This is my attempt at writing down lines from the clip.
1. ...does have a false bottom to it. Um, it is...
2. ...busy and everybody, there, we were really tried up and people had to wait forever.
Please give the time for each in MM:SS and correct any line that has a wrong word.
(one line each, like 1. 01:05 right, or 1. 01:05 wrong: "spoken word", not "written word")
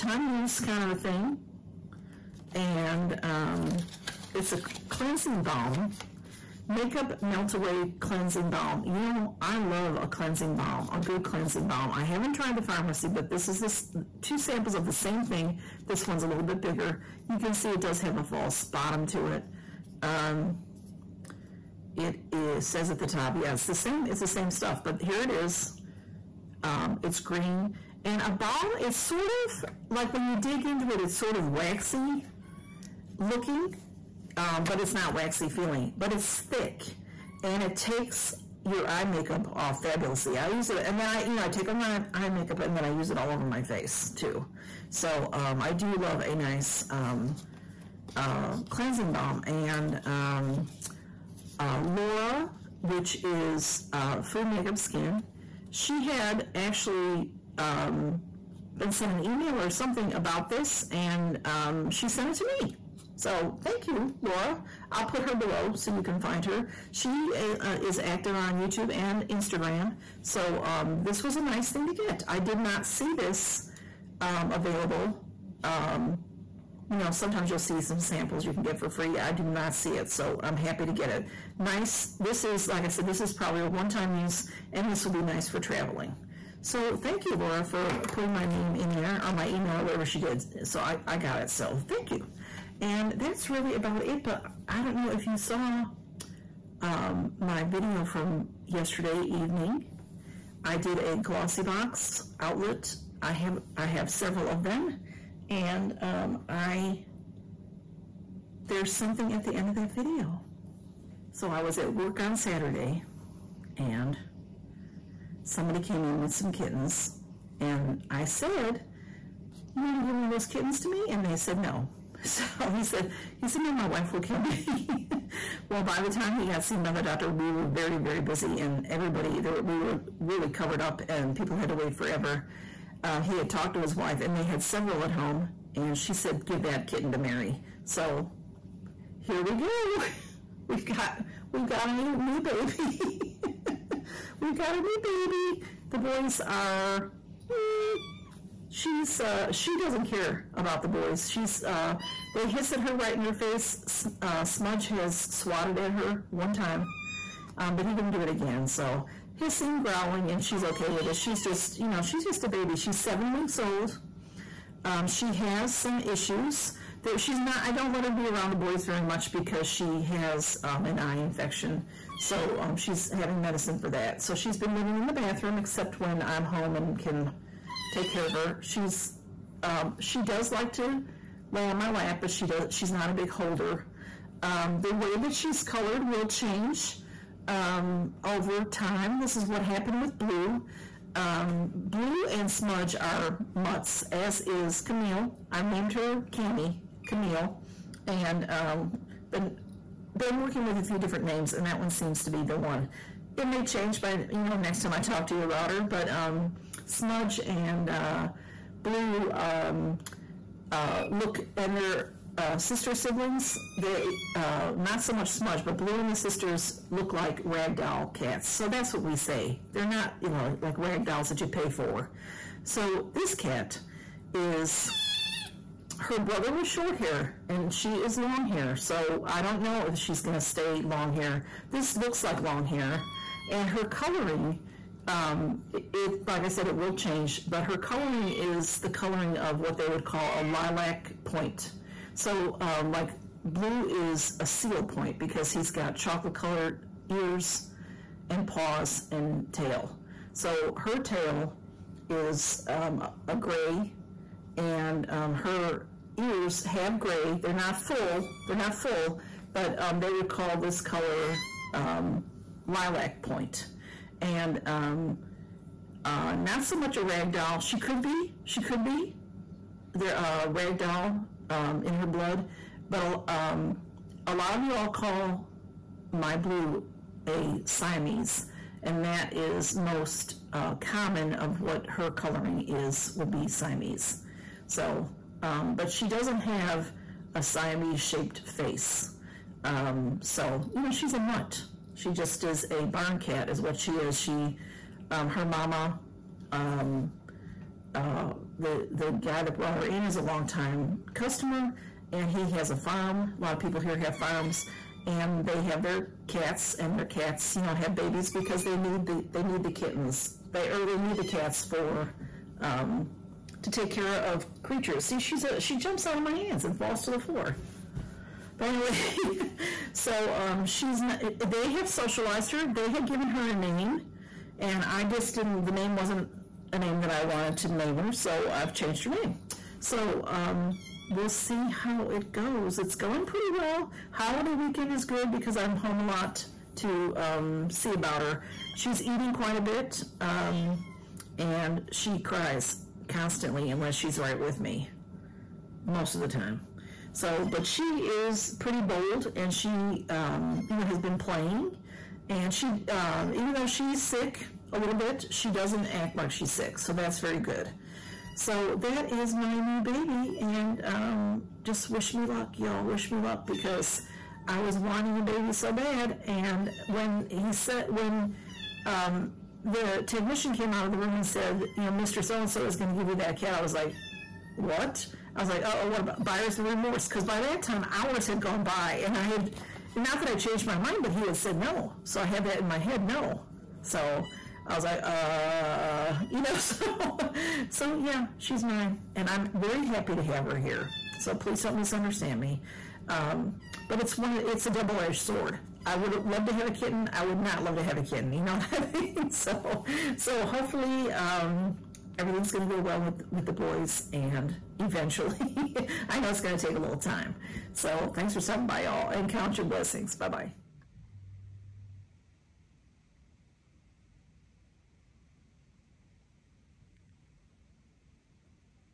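1. 00:17 right
2. 02:08 wrong: "covered", not "tried".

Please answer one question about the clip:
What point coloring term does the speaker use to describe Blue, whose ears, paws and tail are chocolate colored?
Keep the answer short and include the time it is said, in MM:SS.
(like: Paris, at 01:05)
Seal point, at 04:04.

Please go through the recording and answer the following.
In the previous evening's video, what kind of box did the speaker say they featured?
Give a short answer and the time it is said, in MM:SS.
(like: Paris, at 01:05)
Glossy box outlet, at 01:41.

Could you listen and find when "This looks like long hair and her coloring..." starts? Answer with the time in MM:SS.
03:51.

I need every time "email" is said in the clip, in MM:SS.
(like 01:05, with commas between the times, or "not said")
00:59, 01:29.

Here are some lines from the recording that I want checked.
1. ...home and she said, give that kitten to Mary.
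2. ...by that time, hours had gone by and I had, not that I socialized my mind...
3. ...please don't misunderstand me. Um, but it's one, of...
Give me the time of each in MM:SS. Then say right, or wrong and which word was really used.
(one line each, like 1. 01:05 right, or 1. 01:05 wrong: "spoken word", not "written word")
1. 02:15 right
2. 06:17 wrong: "changed", not "socialized"
3. 06:31 right.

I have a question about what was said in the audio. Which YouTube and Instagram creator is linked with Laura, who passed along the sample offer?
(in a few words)
Food Makeup Skin.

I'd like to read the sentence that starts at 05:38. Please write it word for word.
She's eating quite a bit um, and she cries constantly unless she's right with me most of the time.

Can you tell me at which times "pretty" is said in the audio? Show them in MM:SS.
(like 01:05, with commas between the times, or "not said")
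05:33, 05:48.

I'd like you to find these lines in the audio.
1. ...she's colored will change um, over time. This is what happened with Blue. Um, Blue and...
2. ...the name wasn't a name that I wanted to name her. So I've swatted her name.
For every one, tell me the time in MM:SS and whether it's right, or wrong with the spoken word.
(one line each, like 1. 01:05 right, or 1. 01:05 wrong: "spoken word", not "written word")
1. 03:05 right
2. 05:25 wrong: "changed", not "swatted".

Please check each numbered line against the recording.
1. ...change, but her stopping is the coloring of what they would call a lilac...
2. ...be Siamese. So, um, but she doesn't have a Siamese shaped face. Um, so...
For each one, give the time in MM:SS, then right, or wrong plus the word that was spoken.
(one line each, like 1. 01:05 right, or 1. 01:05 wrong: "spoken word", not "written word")
1. 03:56 wrong: "coloring", not "stopping"
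2. 04:43 right.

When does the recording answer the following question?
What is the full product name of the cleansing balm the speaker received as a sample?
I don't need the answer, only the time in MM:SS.
00:06.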